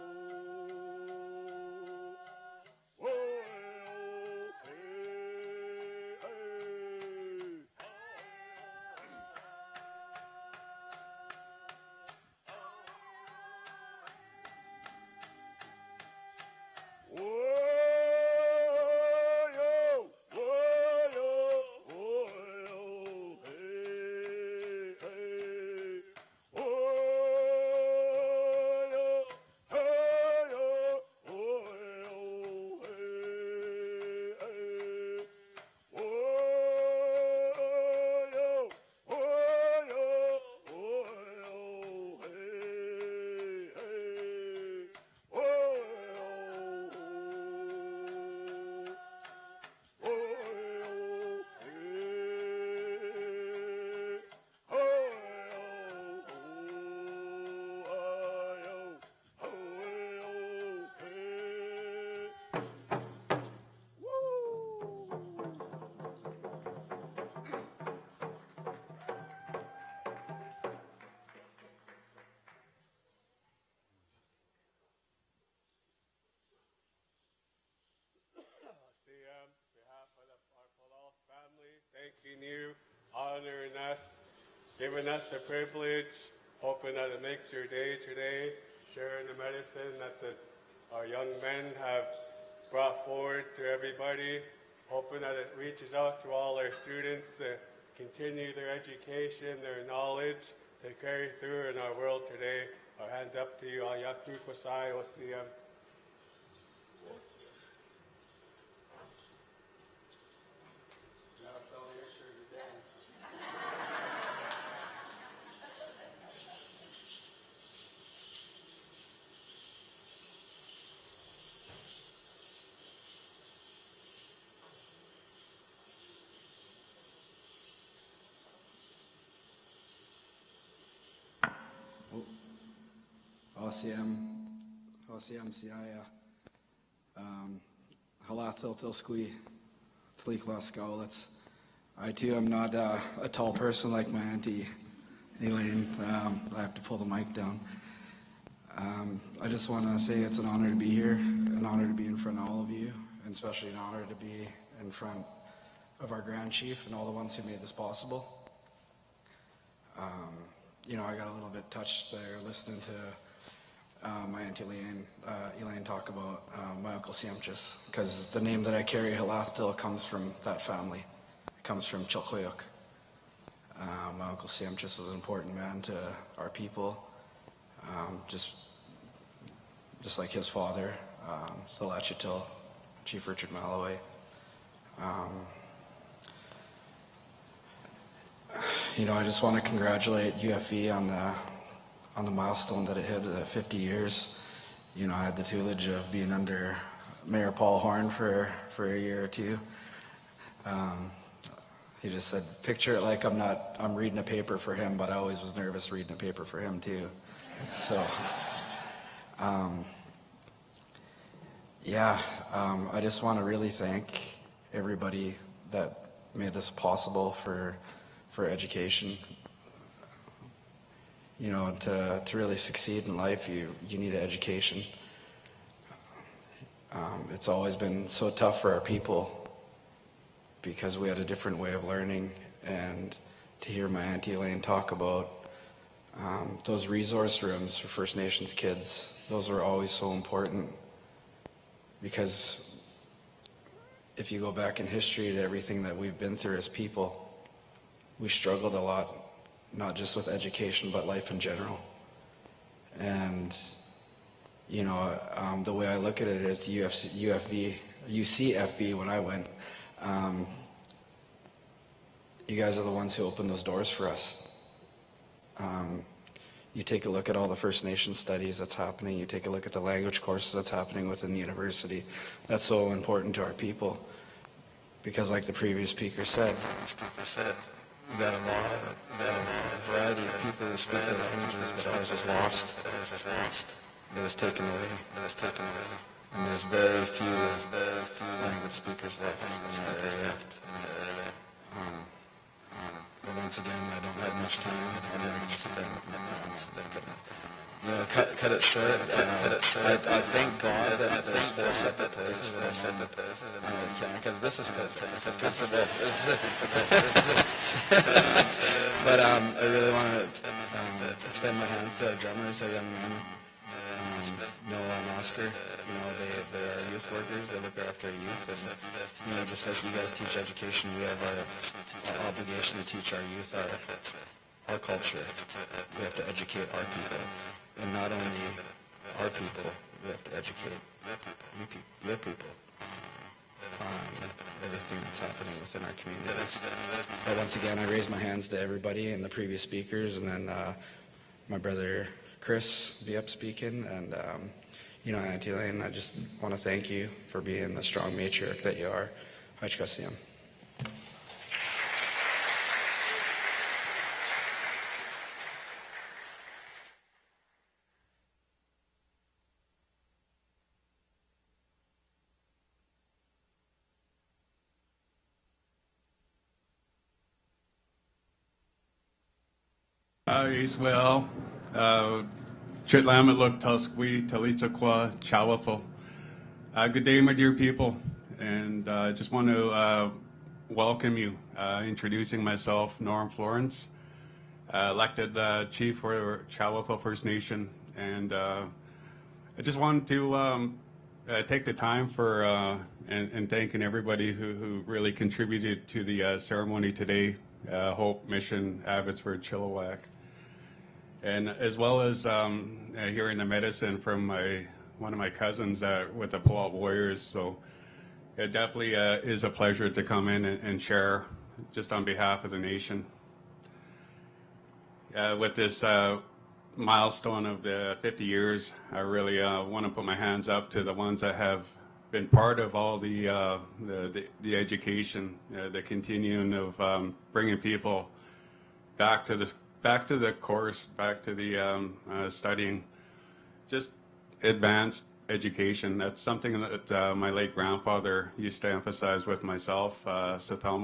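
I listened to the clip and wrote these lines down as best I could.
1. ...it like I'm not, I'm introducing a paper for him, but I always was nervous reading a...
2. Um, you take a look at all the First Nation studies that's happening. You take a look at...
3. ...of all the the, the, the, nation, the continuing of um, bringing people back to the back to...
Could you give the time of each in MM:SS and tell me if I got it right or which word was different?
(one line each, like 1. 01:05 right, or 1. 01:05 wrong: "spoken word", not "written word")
1. 03:22 wrong: "reading", not "introducing"
2. 04:25 right
3. 07:02 wrong: "education", not "nation".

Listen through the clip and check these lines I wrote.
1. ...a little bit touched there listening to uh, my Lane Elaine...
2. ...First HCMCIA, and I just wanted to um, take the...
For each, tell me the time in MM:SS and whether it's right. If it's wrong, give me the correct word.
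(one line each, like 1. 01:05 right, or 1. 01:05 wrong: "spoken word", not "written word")
1. 02:41 wrong: "Aunt", not "Lane"
2. 06:27 wrong: "Nation", not "HCMCIA".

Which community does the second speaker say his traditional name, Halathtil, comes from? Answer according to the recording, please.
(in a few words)
Chilkoyuk.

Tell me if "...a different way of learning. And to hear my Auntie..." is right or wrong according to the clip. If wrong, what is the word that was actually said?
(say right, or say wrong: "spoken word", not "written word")
right.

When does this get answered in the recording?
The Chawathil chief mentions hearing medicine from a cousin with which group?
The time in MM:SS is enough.
06:46.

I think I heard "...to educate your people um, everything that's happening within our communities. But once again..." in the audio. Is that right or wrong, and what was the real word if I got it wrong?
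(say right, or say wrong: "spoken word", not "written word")
right.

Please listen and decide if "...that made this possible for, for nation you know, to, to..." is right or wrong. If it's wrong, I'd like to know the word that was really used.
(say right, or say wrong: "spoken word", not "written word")
wrong: "education", not "nation".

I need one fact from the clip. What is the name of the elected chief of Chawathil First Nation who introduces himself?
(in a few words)
Norm Florence.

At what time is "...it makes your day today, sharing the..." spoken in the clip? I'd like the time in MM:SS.
01:27.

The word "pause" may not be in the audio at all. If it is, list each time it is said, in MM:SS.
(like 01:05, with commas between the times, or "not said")
not said.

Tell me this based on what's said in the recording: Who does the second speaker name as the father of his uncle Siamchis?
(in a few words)
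Chief Richard Malloway.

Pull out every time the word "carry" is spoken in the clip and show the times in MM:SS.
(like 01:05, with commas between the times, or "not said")
01:40, 02:48.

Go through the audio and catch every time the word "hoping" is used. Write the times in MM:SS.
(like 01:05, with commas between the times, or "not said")
01:26, 01:34.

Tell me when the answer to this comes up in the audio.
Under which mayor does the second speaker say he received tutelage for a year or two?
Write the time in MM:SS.
03:17.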